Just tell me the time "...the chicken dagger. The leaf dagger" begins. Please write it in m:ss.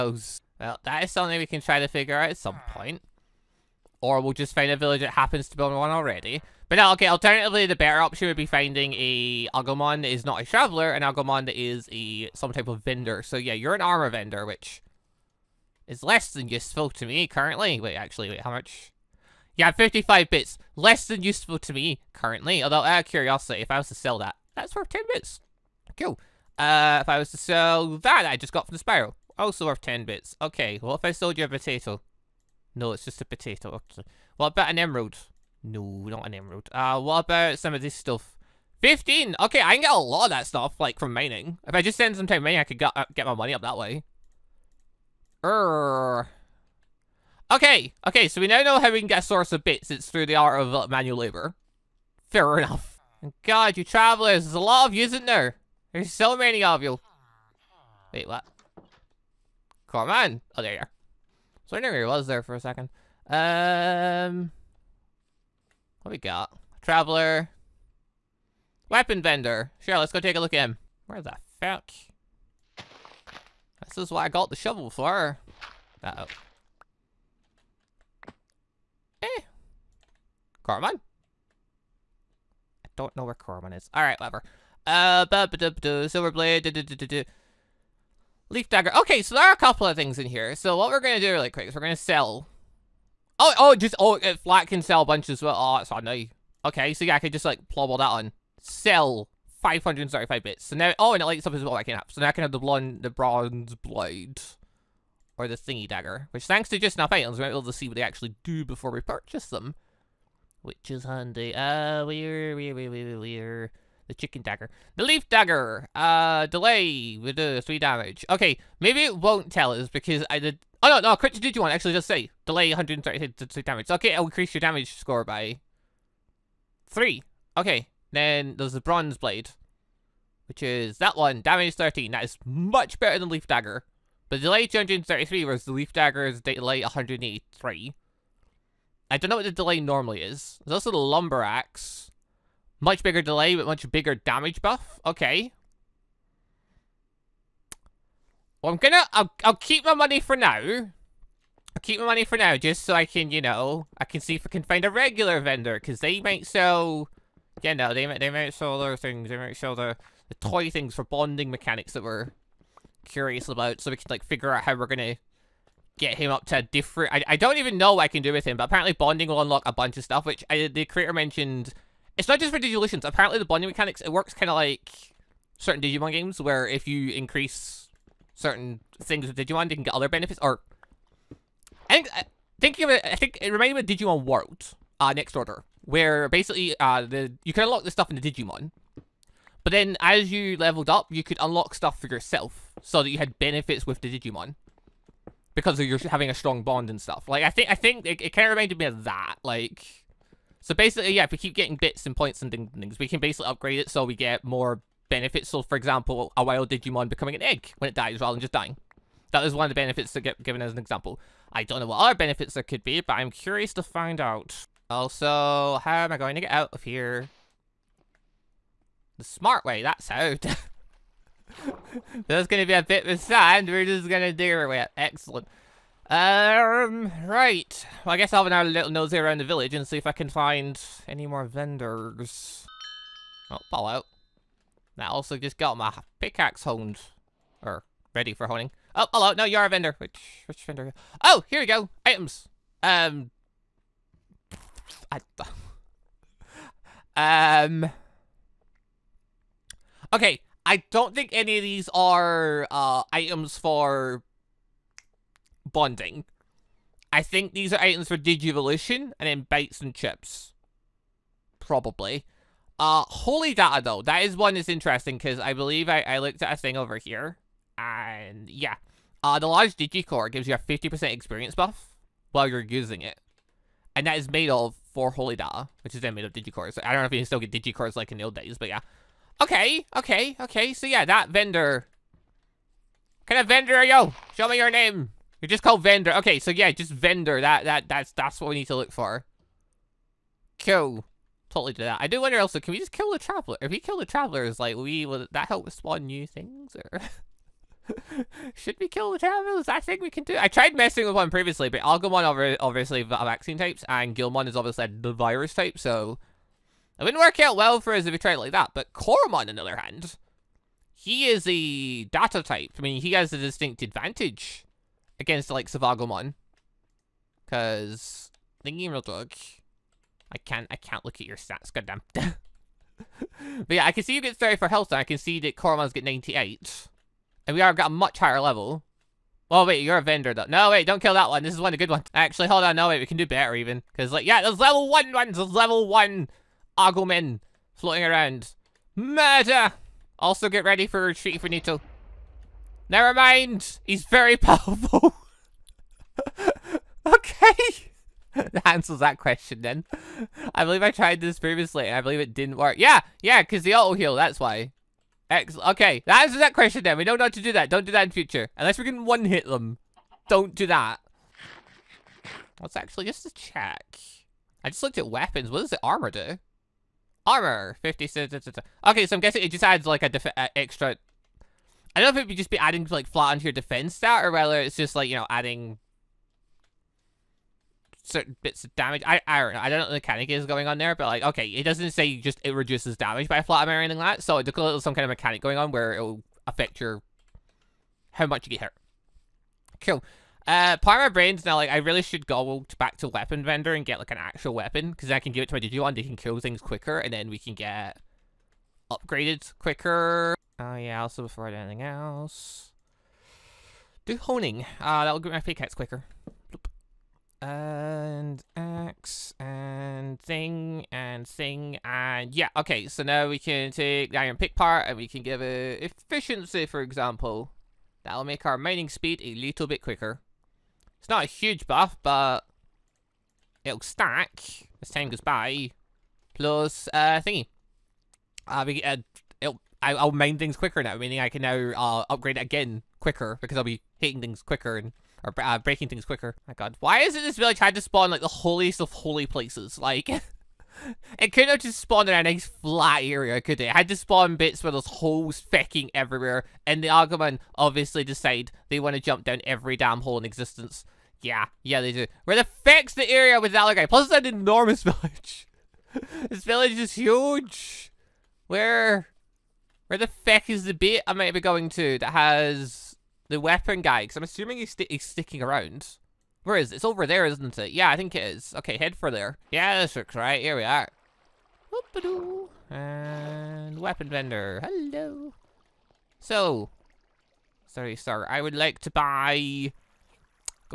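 1:54.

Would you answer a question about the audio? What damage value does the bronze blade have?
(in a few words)
13.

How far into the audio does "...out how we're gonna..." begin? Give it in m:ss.
2:44.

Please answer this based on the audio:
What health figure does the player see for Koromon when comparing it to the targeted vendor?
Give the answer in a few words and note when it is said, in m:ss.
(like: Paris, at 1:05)
98, at 5:26.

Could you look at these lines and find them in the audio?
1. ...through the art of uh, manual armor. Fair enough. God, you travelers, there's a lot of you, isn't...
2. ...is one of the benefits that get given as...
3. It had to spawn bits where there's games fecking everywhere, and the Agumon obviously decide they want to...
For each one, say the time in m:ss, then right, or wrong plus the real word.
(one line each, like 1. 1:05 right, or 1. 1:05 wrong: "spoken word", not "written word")
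1. 0:50 wrong: "labor", not "armor"
2. 3:29 right
3. 7:23 wrong: "holes", not "games".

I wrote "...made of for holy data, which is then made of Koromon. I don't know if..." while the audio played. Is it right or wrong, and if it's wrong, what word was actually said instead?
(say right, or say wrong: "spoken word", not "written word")
wrong: "Digicores", not "Koromon".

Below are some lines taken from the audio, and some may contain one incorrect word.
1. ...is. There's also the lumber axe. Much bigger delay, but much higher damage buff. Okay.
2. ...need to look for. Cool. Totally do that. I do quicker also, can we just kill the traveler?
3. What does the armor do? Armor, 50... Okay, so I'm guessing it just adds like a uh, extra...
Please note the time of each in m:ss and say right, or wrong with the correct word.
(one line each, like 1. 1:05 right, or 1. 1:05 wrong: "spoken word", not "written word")
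1. 2:20 wrong: "bigger", not "higher"
2. 4:48 wrong: "wonder", not "quicker"
3. 6:05 right.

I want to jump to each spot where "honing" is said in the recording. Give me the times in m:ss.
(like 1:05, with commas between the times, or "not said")
3:58, 6:44.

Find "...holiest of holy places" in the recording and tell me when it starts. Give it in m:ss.
7:18.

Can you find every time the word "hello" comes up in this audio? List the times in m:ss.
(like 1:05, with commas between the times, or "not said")
3:59, 7:54.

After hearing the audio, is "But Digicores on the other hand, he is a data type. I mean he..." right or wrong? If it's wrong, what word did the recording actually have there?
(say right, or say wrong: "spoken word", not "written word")
wrong: "Koromon", not "Digicores".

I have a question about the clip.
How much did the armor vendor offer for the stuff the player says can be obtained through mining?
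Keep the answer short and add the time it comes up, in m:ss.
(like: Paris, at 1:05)
15, at 0:38.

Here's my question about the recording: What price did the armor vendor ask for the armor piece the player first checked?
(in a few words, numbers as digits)
55 bits.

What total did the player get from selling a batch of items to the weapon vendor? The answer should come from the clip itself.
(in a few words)
535 bits.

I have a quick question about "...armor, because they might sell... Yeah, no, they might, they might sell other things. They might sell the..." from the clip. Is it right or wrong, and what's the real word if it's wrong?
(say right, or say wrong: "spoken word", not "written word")
wrong: "vendor", not "armor".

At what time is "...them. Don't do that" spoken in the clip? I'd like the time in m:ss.
5:59.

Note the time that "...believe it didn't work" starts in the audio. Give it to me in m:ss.
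5:52.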